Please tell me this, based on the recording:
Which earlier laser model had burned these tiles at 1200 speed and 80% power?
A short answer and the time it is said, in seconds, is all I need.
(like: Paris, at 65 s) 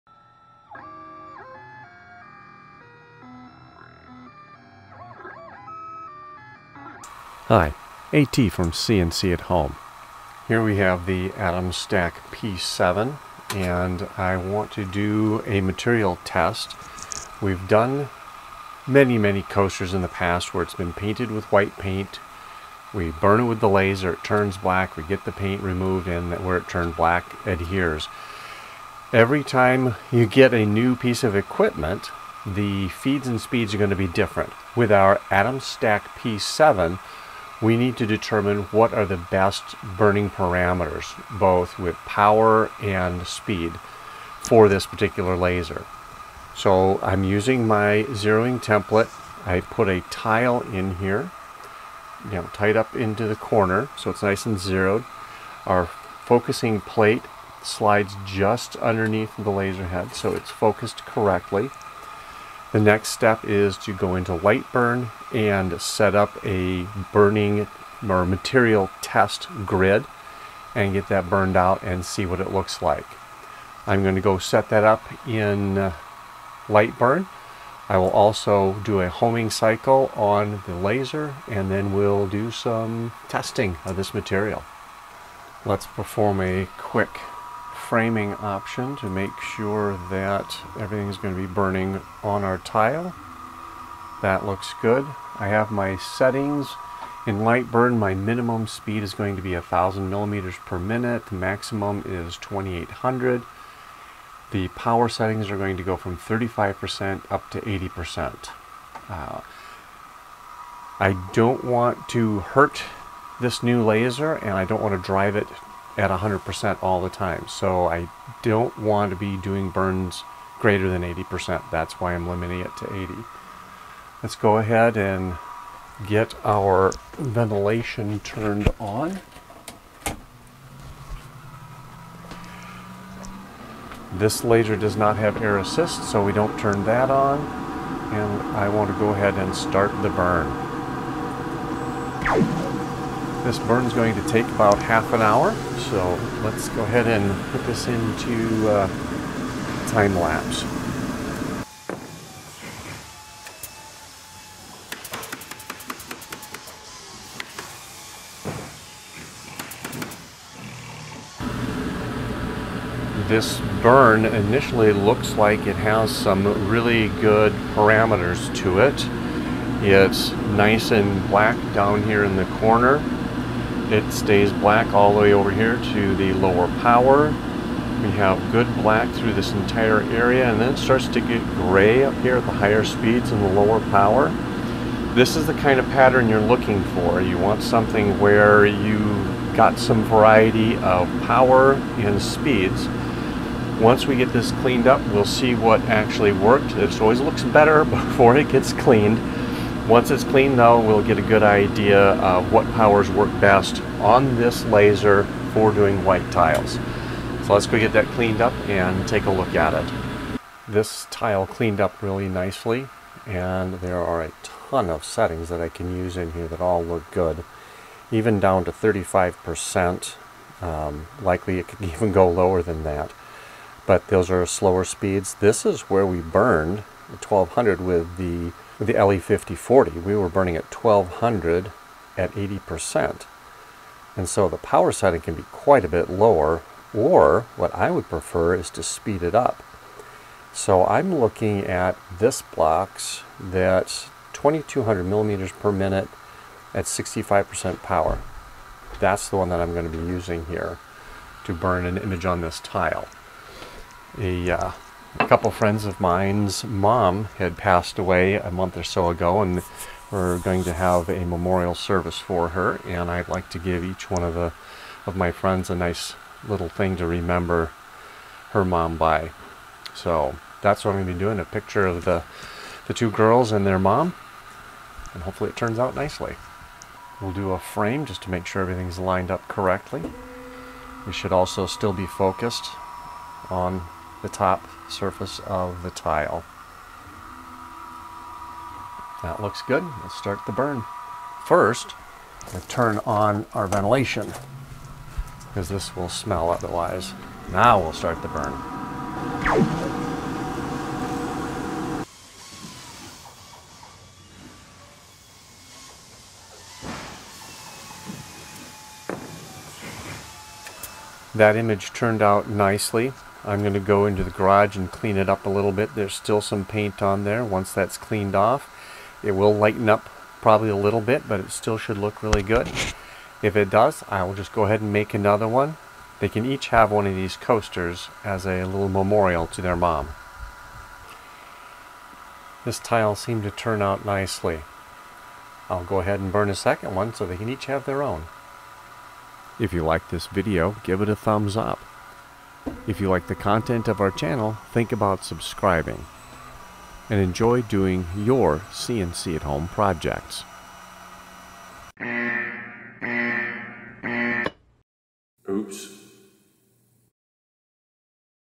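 LE 5040, at 229 s.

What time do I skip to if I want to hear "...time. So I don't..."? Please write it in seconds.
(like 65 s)
117 s.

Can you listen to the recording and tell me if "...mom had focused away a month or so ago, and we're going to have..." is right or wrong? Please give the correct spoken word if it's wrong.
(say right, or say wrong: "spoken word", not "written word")
wrong: "passed", not "focused".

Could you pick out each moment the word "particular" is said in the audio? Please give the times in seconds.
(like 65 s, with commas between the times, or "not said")
44 s.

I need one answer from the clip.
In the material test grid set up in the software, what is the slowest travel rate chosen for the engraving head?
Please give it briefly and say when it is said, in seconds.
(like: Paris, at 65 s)
1,000 millimeters per minute, at 99 s.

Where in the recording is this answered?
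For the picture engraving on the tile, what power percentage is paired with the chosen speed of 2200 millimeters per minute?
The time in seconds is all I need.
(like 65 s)
246 s.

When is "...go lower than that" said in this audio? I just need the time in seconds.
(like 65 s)
222 s.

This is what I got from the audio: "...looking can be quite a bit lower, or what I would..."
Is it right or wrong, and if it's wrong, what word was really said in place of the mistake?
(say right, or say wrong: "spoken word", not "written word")
wrong: "setting", not "looking".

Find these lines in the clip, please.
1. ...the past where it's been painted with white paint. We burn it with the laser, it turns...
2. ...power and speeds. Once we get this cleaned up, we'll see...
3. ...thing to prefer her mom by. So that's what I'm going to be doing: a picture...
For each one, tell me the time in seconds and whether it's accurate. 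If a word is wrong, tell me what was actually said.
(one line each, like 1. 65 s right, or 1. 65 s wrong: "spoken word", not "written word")
1. 20 s right
2. 191 s right
3. 266 s wrong: "remember", not "prefer".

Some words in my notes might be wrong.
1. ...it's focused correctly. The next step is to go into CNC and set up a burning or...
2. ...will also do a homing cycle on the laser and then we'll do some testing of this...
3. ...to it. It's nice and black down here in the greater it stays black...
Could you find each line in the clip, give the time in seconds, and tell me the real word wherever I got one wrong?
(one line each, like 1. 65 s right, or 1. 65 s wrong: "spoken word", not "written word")
1. 60 s wrong: "LightBurn", not "CNC"
2. 77 s right
3. 168 s wrong: "corner", not "greater".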